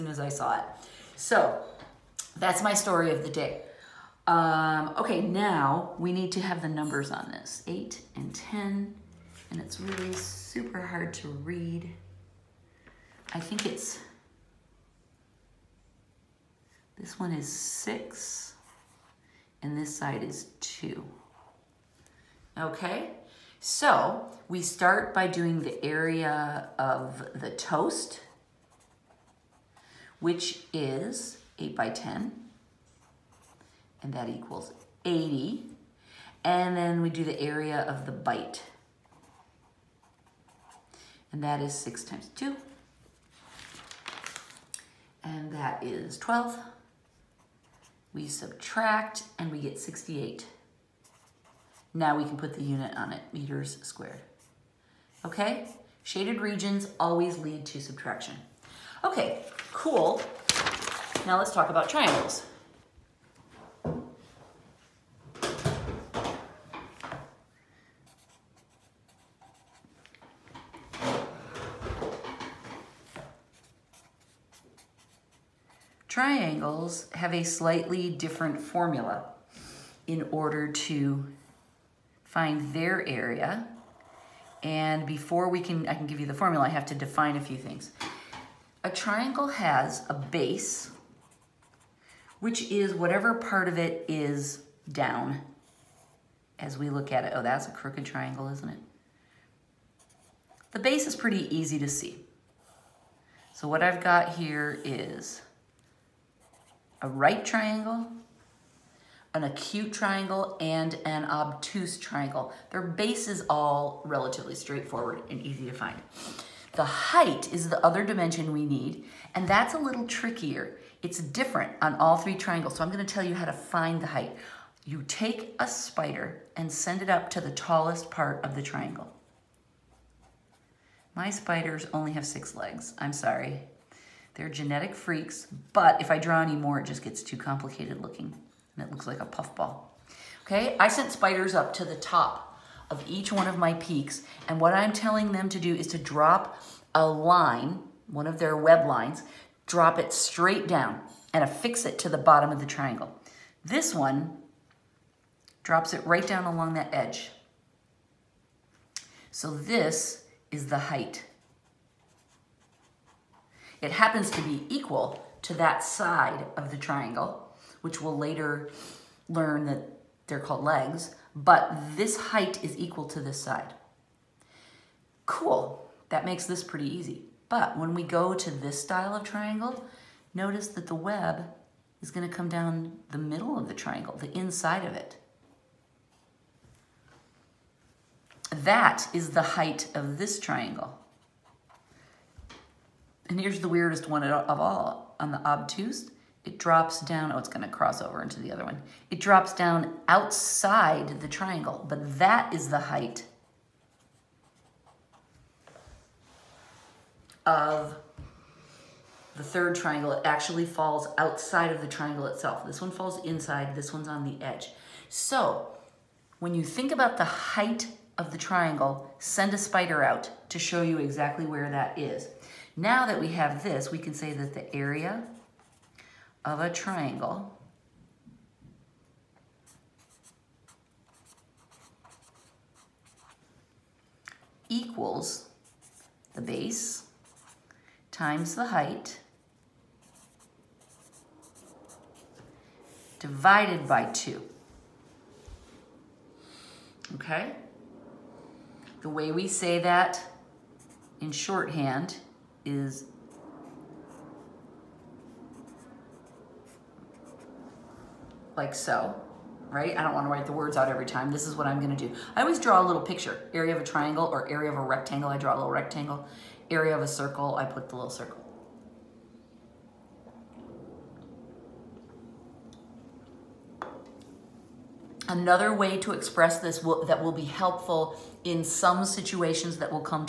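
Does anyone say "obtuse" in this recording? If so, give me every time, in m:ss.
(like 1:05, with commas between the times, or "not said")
1:51, 3:15.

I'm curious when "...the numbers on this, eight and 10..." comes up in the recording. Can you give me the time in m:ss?
0:06.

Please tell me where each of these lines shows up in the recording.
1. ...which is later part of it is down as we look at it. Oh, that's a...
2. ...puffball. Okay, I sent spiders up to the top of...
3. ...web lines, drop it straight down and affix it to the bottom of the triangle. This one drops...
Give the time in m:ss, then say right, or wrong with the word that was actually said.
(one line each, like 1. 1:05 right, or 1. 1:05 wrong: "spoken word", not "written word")
1. 1:32 wrong: "whatever", not "later"
2. 2:19 right
3. 2:28 right.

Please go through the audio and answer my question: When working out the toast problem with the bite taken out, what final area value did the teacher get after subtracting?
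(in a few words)
68.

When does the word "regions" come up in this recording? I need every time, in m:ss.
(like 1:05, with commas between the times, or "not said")
0:56.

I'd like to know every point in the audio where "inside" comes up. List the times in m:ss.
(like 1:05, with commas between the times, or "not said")
3:04, 3:33.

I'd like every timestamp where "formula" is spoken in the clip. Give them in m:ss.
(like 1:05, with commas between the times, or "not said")
1:18, 1:26.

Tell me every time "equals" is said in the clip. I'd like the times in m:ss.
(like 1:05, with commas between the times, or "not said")
0:34, 2:44, 2:52, 3:54.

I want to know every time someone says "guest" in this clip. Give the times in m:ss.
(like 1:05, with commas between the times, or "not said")
not said.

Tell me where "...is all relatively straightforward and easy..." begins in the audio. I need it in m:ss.
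1:53.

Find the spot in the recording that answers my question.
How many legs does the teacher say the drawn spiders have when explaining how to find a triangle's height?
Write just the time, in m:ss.
2:12.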